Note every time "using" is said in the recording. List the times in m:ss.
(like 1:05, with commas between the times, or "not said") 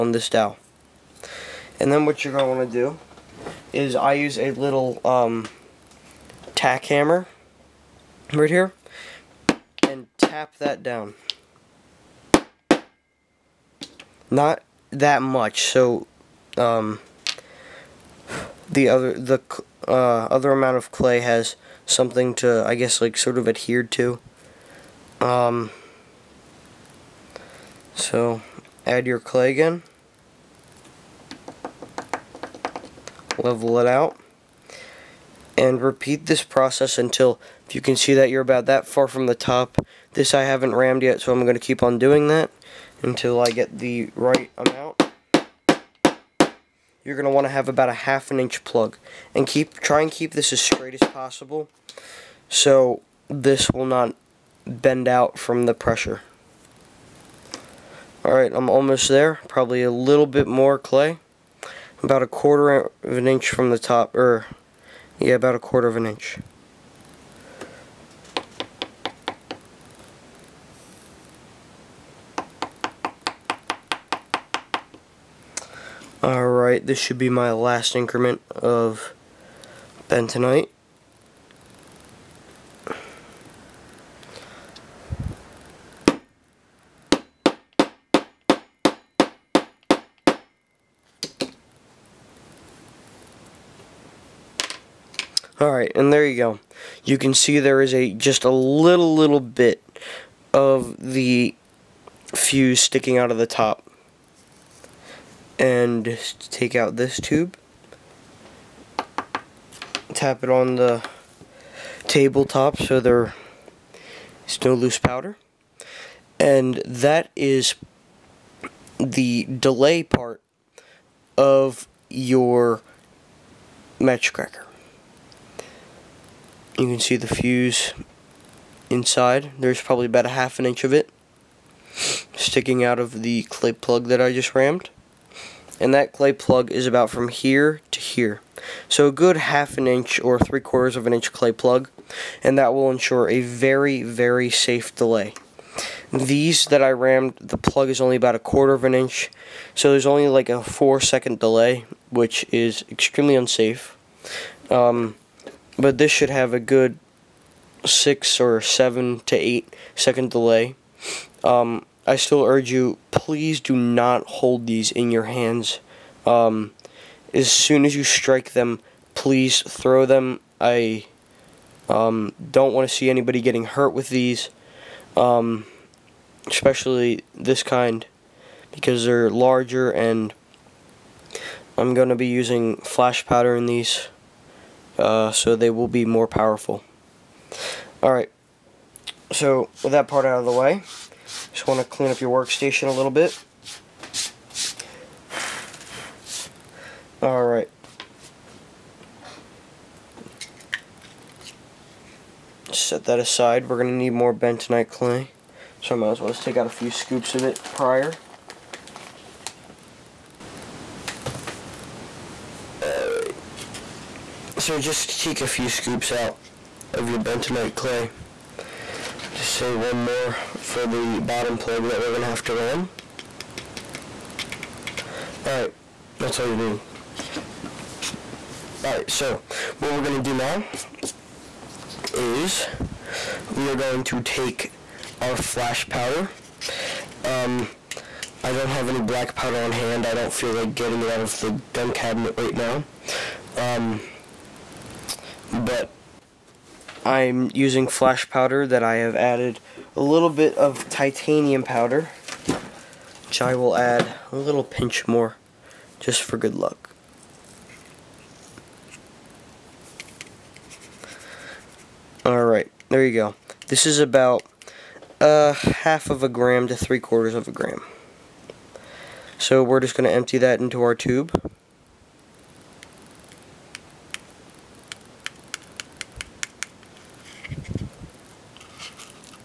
3:02, 4:07.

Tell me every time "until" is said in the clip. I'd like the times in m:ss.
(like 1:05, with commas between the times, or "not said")
0:36, 0:43.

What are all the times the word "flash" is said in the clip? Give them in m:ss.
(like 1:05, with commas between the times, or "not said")
3:02, 3:55, 4:07.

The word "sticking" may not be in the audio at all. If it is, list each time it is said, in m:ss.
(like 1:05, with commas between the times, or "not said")
1:42, 2:12.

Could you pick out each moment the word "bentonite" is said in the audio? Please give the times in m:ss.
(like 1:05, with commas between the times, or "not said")
1:20, 3:24, 3:37.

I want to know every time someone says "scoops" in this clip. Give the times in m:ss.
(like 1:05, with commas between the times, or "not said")
3:26, 3:35.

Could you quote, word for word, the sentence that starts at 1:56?
And that is the delay part of your match cracker.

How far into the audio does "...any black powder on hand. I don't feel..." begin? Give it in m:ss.
3:58.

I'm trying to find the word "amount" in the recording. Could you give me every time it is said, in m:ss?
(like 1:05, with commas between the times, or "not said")
0:20, 0:44.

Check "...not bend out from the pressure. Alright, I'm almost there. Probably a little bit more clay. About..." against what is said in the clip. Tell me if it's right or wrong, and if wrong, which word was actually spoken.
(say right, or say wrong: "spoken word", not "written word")
right.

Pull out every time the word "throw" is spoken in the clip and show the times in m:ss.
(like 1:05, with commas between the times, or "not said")
2:49.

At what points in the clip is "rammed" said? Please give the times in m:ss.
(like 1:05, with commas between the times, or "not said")
0:40, 2:14, 2:26.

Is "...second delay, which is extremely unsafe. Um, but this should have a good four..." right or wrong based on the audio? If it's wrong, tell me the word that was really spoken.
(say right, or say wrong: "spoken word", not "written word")
wrong: "six", not "four".